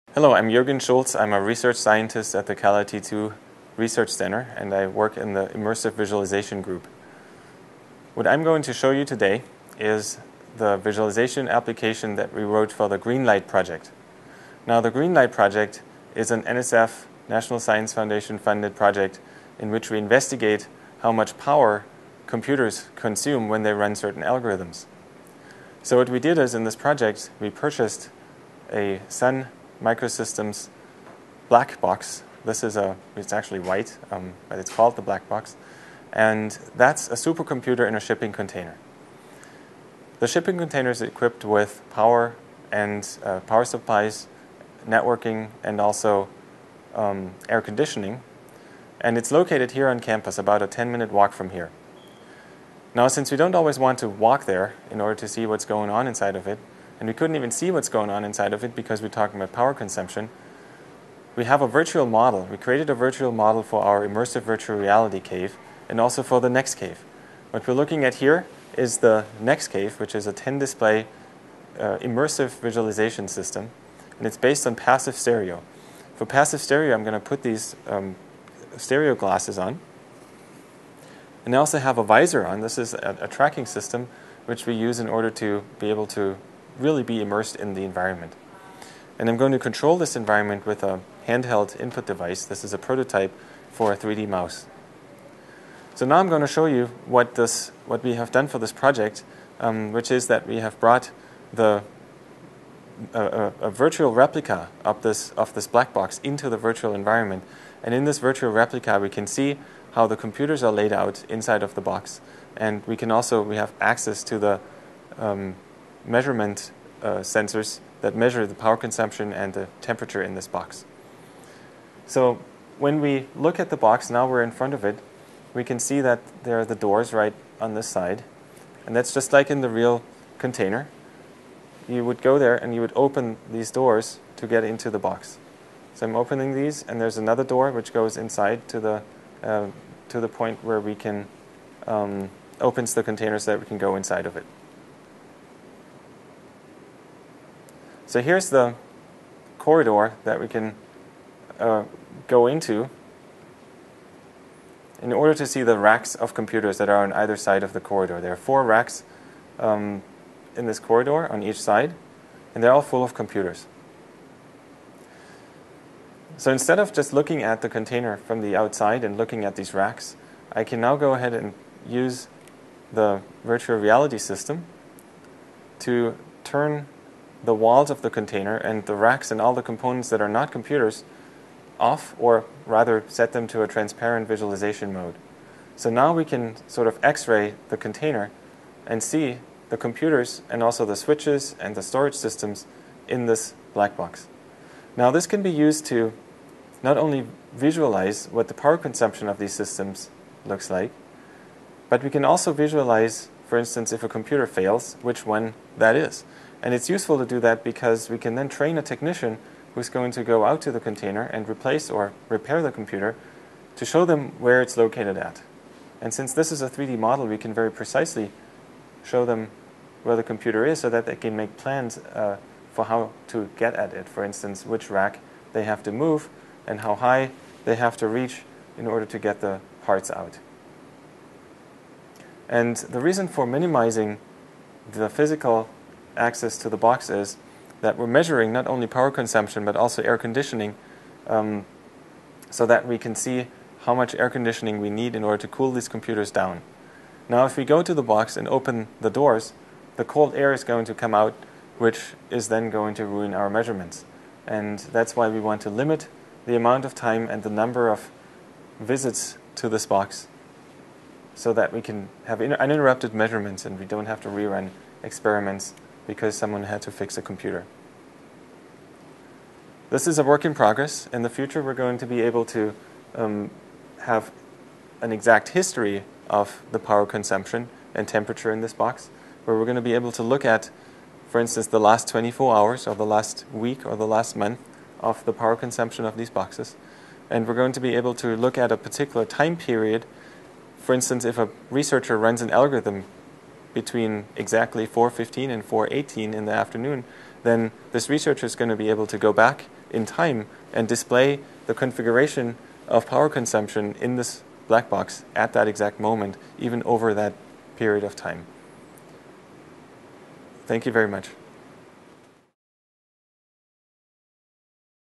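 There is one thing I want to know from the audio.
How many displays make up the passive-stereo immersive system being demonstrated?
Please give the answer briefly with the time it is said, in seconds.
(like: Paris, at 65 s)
10, at 70 s.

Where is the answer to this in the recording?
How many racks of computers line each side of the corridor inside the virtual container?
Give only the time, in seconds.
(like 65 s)
158 s.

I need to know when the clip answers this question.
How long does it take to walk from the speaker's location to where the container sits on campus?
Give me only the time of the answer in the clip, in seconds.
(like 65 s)
50 s.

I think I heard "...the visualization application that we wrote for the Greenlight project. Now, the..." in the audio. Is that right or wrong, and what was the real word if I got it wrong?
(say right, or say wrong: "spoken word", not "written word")
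right.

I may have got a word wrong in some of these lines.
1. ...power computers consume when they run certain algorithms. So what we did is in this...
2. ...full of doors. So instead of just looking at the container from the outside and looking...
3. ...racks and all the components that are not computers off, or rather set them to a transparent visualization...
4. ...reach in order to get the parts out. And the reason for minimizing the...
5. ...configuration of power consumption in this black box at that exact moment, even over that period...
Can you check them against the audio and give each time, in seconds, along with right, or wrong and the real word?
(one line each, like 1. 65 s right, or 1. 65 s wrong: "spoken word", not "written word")
1. 21 s right
2. 162 s wrong: "computers", not "doors"
3. 178 s right
4. 228 s right
5. 301 s right.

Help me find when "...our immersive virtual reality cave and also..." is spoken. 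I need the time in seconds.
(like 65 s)
63 s.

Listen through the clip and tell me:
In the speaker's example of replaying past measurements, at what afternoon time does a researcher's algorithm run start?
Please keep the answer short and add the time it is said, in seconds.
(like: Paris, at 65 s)
4:15, at 294 s.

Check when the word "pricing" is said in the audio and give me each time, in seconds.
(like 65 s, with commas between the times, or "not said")
not said.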